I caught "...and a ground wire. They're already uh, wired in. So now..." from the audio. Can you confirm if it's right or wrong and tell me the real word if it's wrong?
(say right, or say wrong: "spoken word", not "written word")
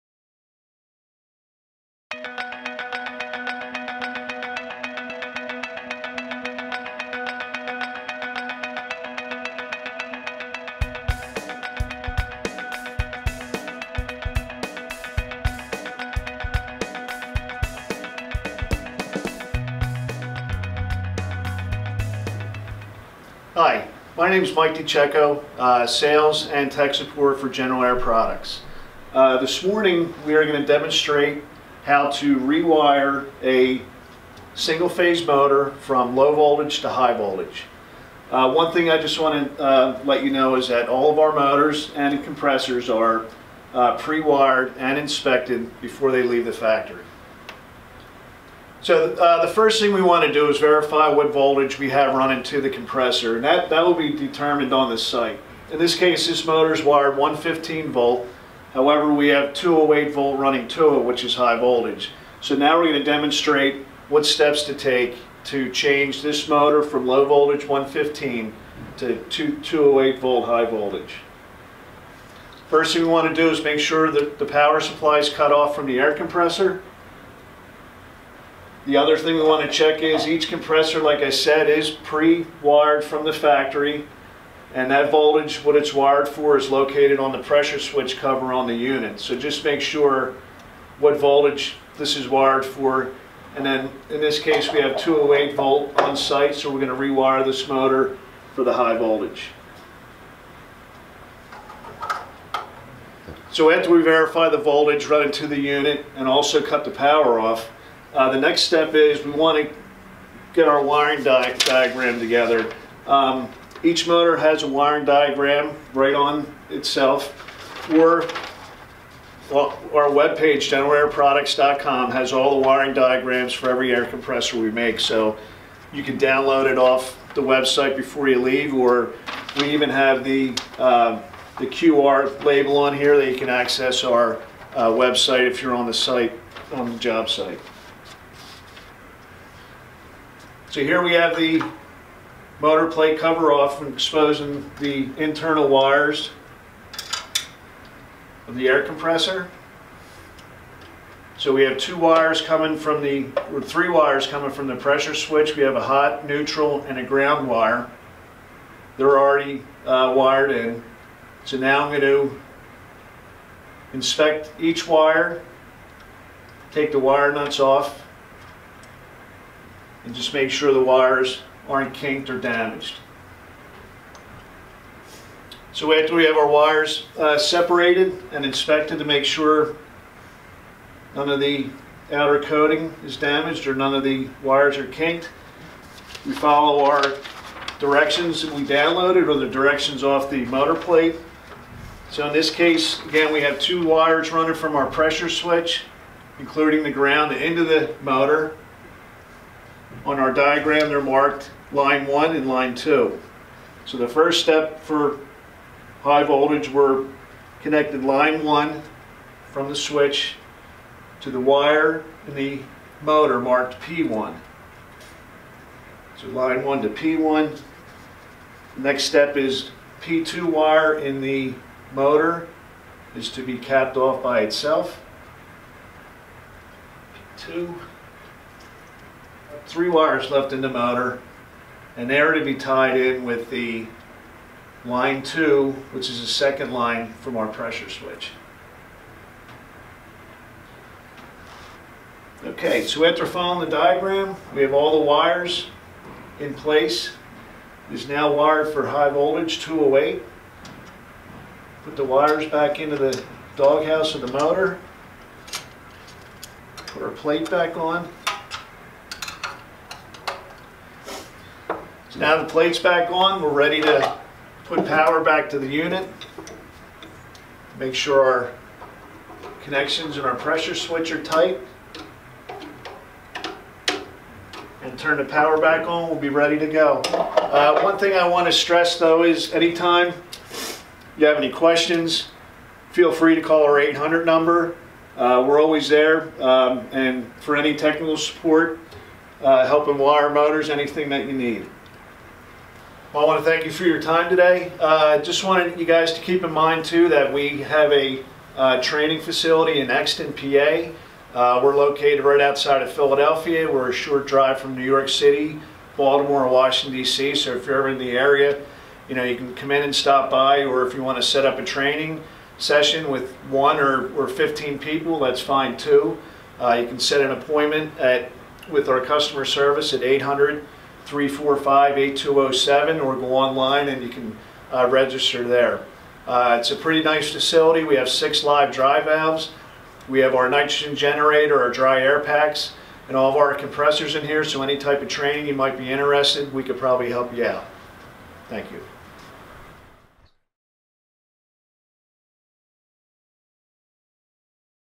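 right.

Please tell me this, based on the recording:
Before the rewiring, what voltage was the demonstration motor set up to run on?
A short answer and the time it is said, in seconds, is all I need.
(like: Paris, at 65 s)
115 volt, at 57 s.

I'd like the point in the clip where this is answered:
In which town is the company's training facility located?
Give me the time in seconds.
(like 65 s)
299 s.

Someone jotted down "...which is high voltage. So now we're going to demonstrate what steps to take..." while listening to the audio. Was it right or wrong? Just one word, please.
right.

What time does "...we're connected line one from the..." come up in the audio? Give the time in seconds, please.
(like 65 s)
206 s.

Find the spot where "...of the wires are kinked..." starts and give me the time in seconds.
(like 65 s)
183 s.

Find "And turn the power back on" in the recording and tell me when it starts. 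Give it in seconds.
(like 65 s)
274 s.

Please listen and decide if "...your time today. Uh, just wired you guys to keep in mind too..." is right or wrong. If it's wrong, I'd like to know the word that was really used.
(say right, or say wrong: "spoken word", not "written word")
wrong: "wanted", not "wired".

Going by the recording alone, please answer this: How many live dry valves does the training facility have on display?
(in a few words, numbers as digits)
6.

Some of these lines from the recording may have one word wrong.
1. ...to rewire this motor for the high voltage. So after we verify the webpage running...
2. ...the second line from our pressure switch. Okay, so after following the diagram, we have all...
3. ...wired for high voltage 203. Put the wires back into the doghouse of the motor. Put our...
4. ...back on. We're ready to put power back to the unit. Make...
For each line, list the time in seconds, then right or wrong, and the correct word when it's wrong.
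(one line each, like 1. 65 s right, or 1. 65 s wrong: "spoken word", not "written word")
1. 96 s wrong: "voltage", not "webpage"
2. 236 s right
3. 248 s wrong: "208", not "203"
4. 262 s right.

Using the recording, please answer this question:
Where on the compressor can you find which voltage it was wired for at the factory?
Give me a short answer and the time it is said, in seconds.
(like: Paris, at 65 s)
pressure switch cover, at 87 s.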